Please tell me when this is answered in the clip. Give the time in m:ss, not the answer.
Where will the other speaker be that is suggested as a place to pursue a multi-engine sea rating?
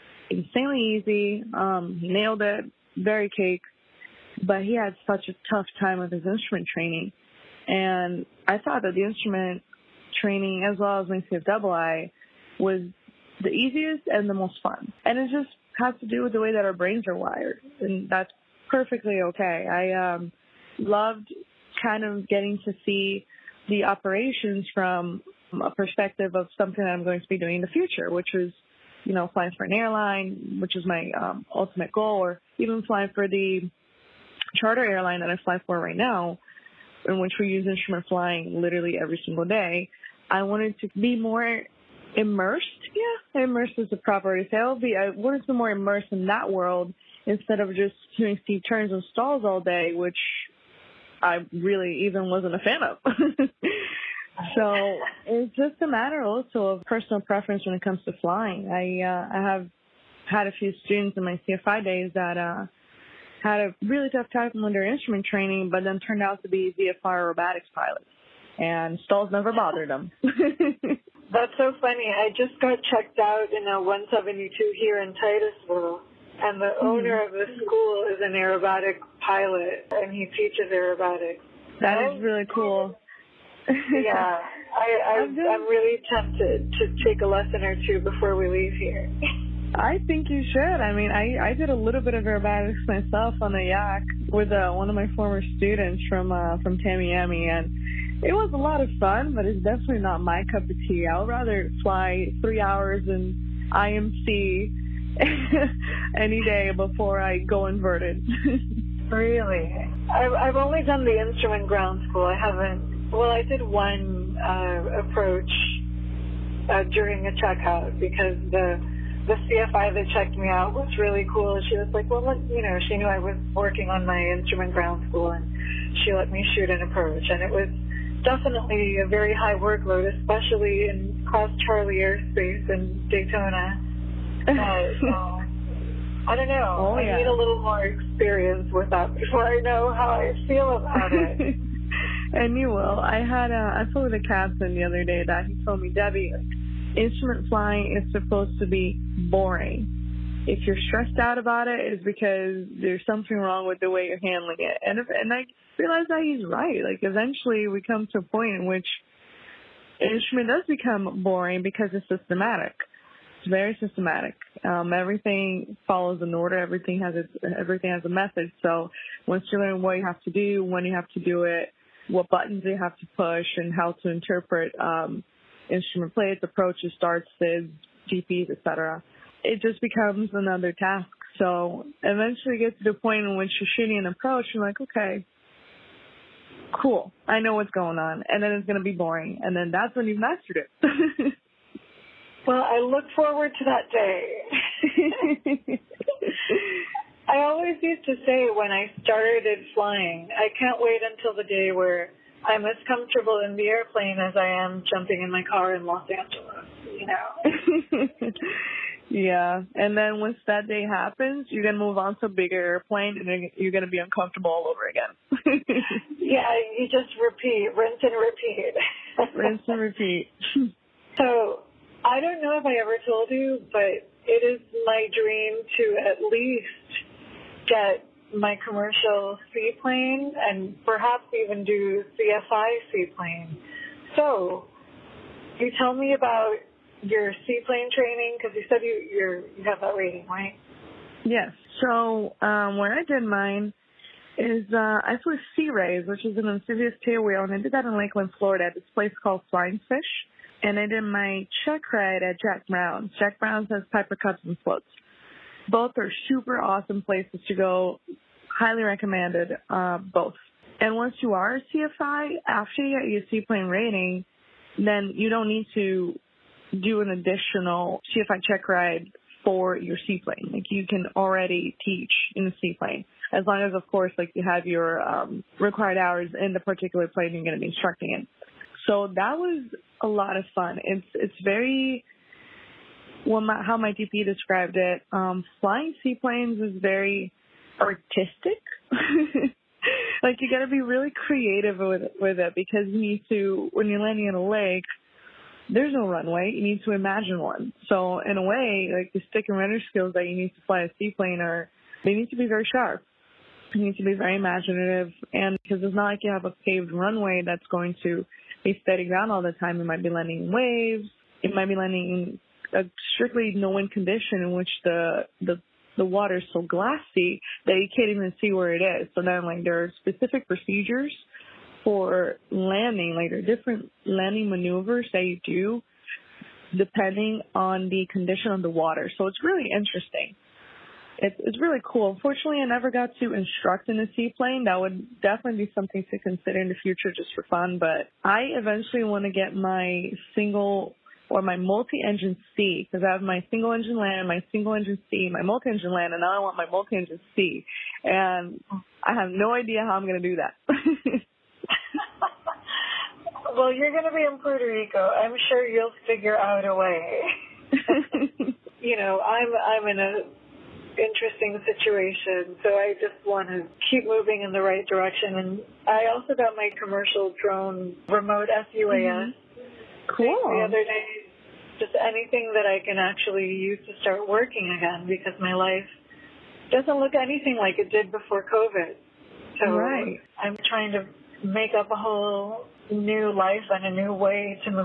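5:54.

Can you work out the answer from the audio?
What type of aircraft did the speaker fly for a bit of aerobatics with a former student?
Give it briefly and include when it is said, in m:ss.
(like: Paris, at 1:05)
Yak, at 1:33.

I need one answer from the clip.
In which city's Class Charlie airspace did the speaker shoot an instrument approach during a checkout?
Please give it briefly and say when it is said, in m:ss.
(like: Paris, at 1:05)
Daytona, at 2:13.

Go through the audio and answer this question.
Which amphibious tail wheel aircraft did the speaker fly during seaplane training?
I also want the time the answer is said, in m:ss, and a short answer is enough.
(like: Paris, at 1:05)
SeaReys, at 4:05.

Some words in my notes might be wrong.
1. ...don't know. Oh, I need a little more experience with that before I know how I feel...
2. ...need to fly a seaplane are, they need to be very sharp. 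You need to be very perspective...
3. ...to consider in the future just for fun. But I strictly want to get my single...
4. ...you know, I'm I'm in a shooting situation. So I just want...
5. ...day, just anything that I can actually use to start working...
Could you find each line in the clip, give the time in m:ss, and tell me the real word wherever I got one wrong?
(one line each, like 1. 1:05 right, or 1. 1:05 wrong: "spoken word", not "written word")
1. 2:16 right
2. 5:00 wrong: "imaginative", not "perspective"
3. 5:36 wrong: "eventually", not "strictly"
4. 5:58 wrong: "interesting", not "shooting"
5. 6:10 right.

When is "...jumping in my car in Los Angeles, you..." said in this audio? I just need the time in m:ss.
3:24.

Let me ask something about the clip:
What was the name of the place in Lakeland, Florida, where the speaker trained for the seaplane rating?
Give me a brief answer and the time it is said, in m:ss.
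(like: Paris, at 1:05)
Flying Fish, at 4:09.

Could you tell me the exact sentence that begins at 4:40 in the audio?
It's it's very well, my, how my DP described it.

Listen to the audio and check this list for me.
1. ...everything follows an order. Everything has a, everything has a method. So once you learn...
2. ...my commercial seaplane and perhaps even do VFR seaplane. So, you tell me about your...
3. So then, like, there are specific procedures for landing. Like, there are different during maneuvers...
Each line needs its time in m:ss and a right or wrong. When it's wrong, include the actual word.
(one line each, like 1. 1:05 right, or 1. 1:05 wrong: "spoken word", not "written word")
1. 2:44 right
2. 3:48 wrong: "CFI", not "VFR"
3. 5:19 wrong: "landing", not "during".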